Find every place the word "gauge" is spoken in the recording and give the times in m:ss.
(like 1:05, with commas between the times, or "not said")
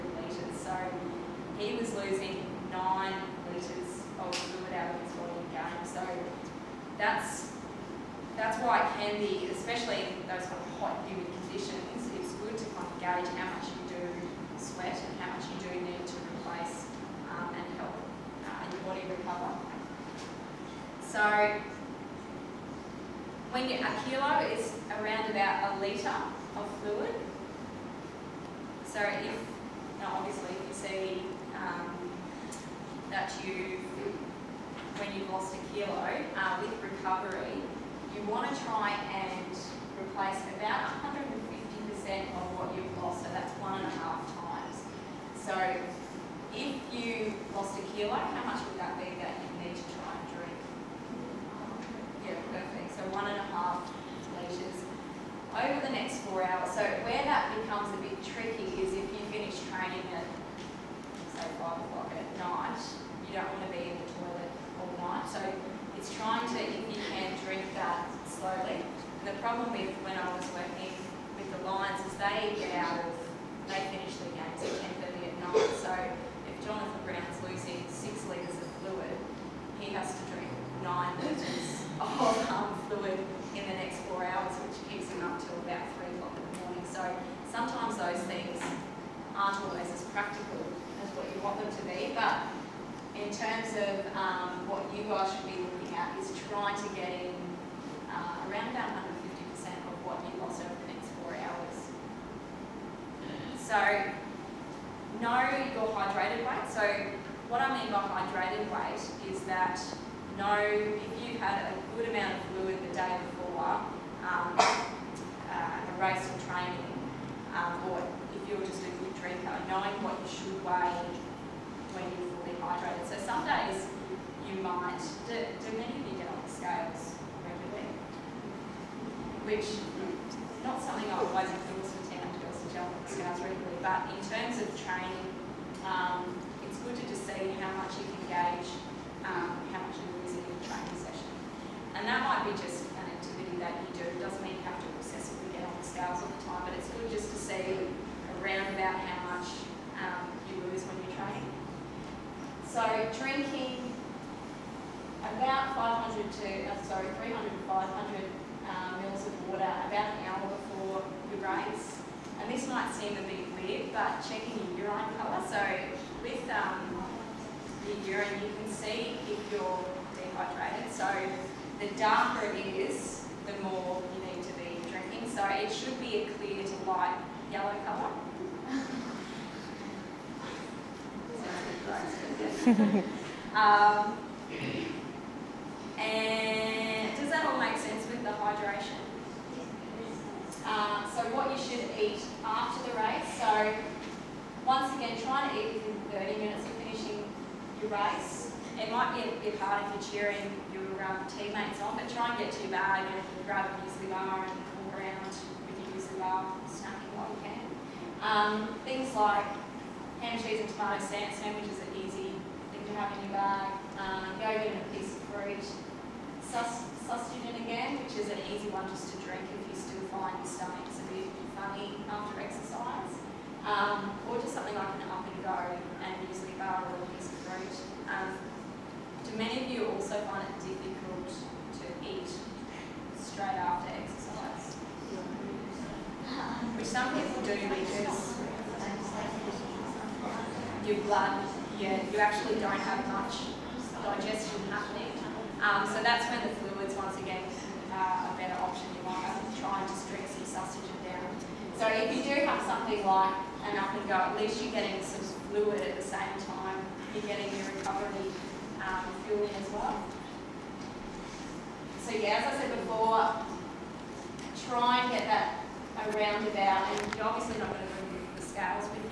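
0:13, 2:18.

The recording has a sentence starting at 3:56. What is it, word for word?
Which some people do because your blood, you, you actually don't have much digestion happening.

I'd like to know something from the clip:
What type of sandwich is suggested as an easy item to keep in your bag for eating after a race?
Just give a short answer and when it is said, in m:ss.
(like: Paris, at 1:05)
Ham, cheese and tomato, at 3:30.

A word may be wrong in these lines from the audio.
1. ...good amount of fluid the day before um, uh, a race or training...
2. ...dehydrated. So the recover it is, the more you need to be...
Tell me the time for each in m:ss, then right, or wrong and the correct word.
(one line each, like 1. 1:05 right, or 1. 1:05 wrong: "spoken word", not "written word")
1. 1:51 right
2. 2:50 wrong: "darker", not "recover".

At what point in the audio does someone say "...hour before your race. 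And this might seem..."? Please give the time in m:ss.
2:40.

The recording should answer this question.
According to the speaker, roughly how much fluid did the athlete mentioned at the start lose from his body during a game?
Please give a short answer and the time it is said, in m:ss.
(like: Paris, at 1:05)
9 litres, at 0:02.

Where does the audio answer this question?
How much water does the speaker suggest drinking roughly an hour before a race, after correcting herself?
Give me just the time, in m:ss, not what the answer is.
2:37.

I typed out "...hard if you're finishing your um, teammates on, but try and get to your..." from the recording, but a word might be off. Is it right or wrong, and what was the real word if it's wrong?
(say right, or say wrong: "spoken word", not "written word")
wrong: "cheering", not "finishing".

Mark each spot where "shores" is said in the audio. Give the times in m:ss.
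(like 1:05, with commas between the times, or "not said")
not said.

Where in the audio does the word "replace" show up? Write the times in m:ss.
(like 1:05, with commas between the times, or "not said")
0:16, 0:40.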